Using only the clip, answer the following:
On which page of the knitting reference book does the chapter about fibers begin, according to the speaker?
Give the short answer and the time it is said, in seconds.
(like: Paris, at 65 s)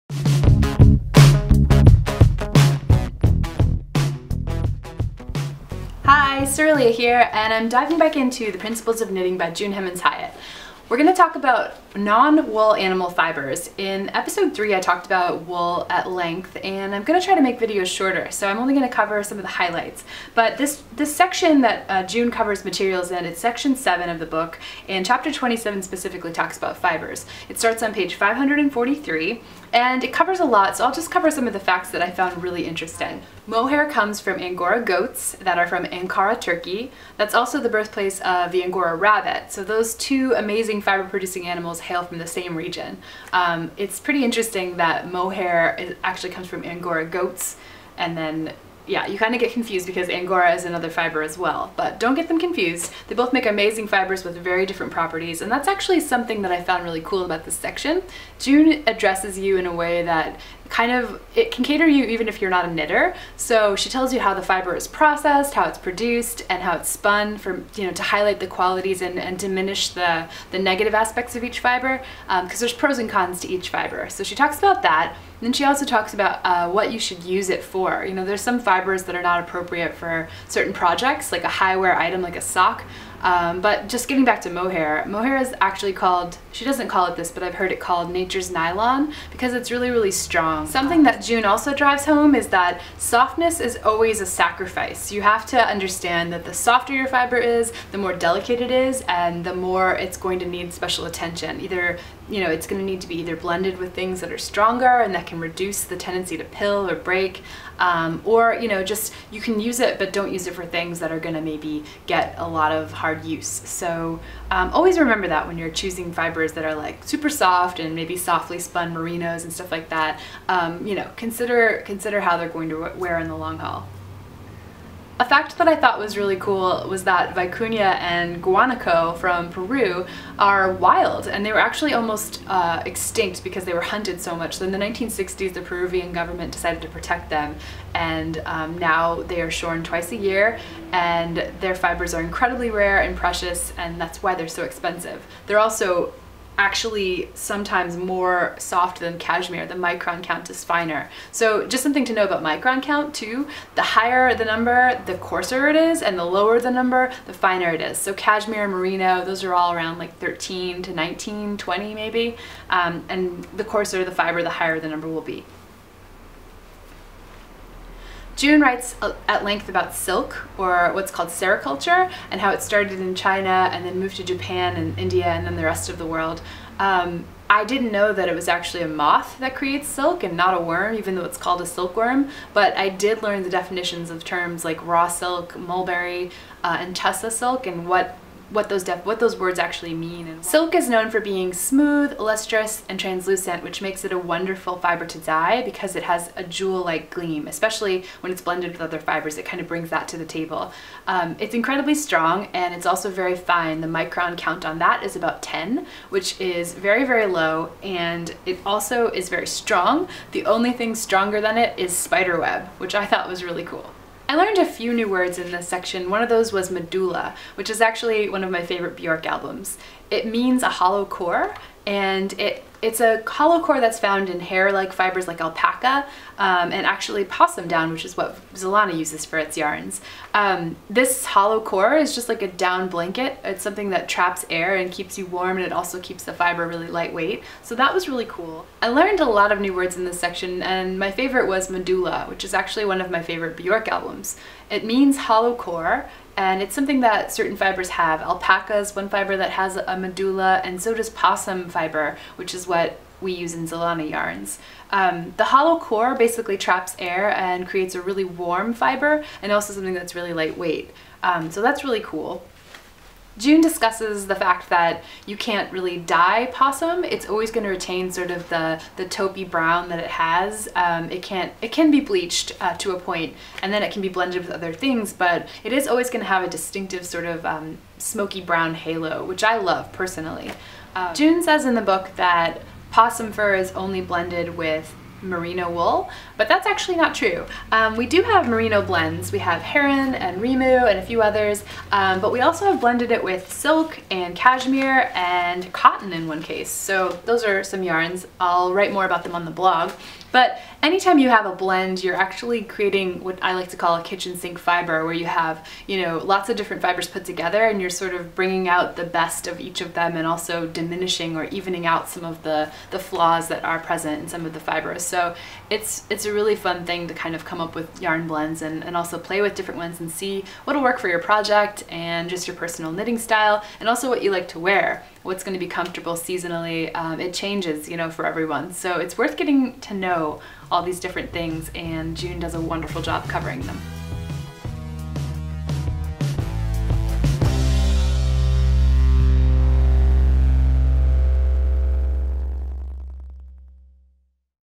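543, at 28 s.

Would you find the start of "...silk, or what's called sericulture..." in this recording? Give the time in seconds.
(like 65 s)
169 s.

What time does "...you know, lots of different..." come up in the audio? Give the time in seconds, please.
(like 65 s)
305 s.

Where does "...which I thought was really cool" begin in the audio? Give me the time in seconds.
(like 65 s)
212 s.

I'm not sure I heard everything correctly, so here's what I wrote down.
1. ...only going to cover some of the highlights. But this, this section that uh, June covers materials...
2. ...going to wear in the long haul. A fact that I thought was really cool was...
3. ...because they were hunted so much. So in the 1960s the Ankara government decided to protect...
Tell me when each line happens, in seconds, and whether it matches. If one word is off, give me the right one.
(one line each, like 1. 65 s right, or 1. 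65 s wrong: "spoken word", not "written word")
1. 18 s right
2. 122 s right
3. 133 s wrong: "Peruvian", not "Ankara".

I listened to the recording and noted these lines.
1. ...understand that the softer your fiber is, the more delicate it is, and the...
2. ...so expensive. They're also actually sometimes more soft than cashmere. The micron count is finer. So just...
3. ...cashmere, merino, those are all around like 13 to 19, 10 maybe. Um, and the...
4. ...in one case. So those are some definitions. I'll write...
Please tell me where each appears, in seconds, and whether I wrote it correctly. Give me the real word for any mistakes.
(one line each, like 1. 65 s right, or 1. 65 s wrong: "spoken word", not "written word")
1. 95 s right
2. 144 s right
3. 158 s wrong: "20", not "10"
4. 296 s wrong: "yarns", not "definitions".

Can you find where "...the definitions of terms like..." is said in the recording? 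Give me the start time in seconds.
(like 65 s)
183 s.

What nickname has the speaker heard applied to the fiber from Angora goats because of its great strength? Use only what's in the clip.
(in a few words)
nature's nylon.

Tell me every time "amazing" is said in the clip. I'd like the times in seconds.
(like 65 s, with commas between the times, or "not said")
40 s, 53 s.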